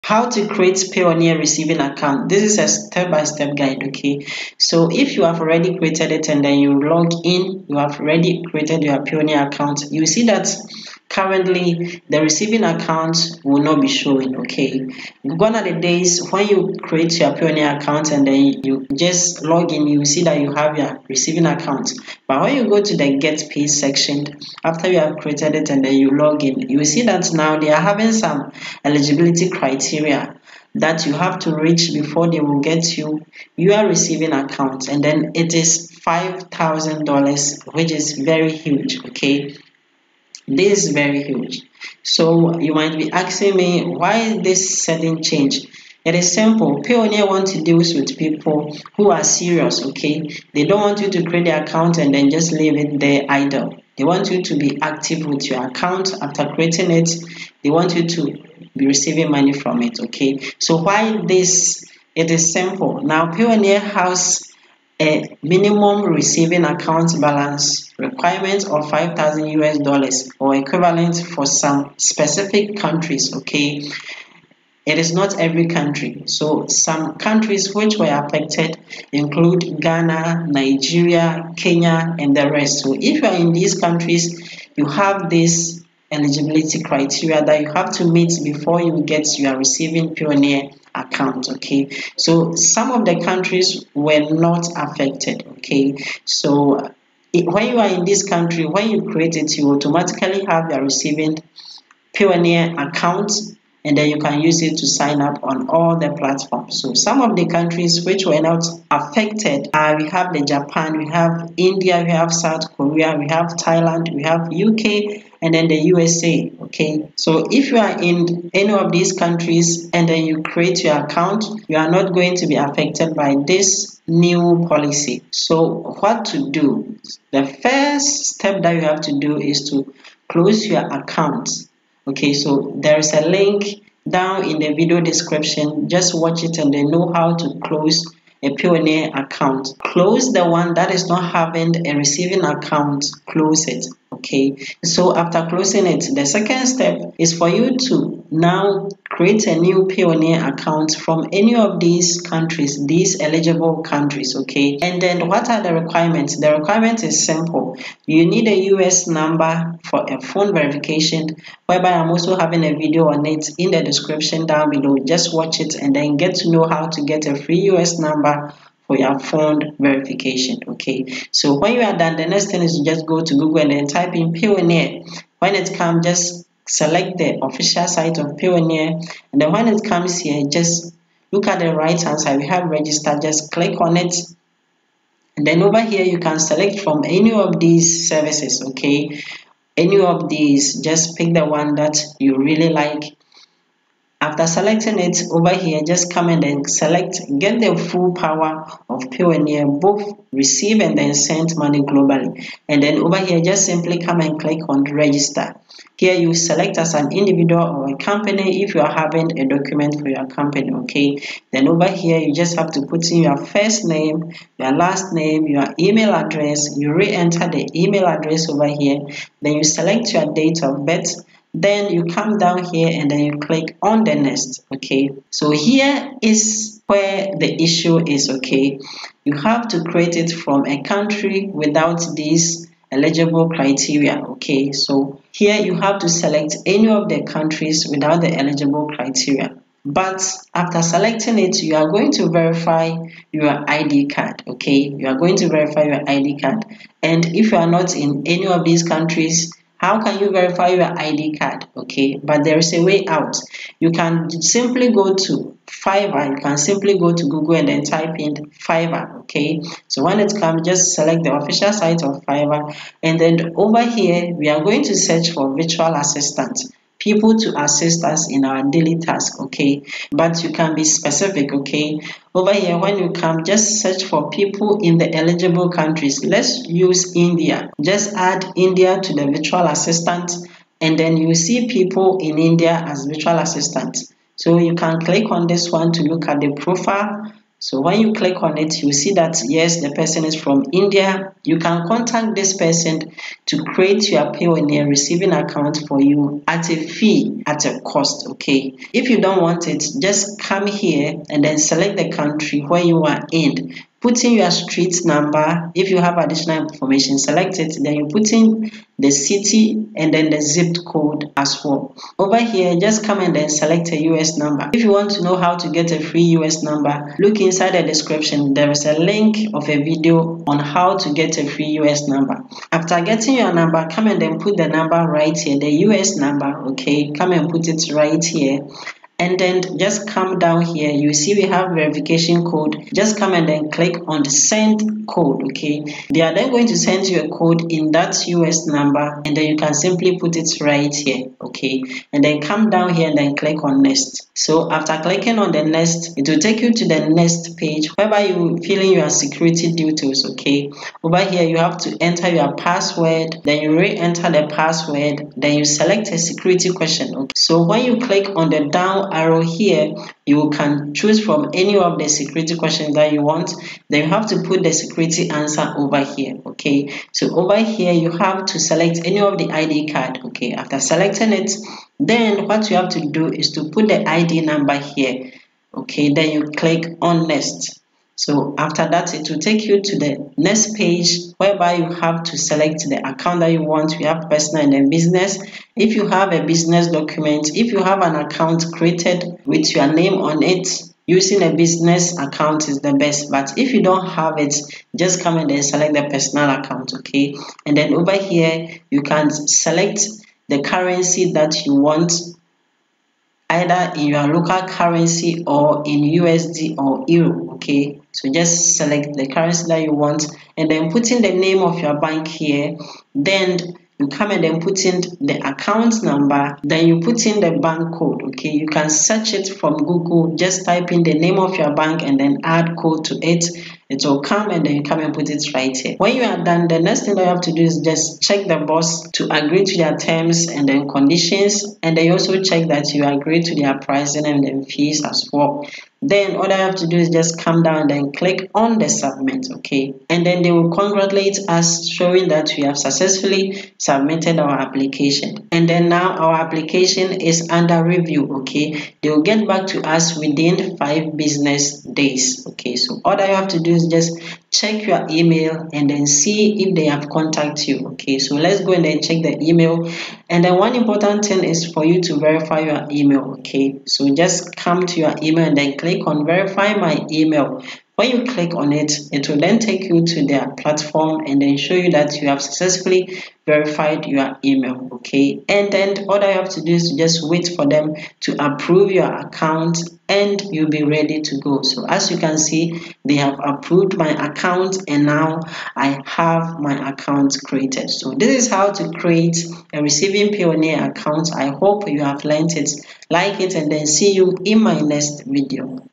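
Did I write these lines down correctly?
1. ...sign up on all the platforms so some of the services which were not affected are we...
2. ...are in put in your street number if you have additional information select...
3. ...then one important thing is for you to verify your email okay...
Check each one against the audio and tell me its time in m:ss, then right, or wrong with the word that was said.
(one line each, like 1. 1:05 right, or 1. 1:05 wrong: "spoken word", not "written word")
1. 1:44 wrong: "countries", not "services"
2. 5:03 right
3. 7:40 right.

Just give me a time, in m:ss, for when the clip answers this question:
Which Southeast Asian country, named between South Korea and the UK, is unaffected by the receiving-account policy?
1:53.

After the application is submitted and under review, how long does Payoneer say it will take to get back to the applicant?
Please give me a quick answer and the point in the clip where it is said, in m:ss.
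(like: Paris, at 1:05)
5 business days, at 7:30.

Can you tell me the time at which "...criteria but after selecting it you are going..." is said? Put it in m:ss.
3:58.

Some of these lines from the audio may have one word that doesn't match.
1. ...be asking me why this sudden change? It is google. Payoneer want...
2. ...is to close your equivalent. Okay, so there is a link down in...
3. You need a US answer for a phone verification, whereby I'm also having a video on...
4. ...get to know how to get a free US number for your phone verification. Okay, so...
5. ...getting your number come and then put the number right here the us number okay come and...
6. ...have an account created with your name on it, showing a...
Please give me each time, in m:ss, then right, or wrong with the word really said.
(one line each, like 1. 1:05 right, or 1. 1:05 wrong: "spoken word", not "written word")
1. 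0:42 wrong: "simple", not "google"
2. 2:09 wrong: "account", not "equivalent"
3. 2:38 wrong: "number", not "answer"
4. 2:46 right
5. 5:23 right
6. 6:27 wrong: "using", not "showing".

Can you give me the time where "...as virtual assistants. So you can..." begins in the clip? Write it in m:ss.
4:42.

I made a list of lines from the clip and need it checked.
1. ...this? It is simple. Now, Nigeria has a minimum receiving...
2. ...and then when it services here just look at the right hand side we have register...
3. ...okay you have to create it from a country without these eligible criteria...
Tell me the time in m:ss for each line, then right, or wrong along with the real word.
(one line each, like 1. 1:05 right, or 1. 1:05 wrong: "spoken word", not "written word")
1. 1:01 wrong: "Payoneer", not "Nigeria"
2. 2:59 wrong: "comes", not "services"
3. 3:48 right.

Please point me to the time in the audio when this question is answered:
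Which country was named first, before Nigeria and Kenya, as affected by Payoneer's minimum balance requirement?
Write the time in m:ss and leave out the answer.
1:19.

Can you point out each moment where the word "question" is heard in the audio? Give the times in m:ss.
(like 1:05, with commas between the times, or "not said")
5:56, 6:02.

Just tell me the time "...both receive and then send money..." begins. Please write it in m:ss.
3:19.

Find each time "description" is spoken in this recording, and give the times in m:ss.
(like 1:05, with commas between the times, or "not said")
2:15, 2:43, 5:17.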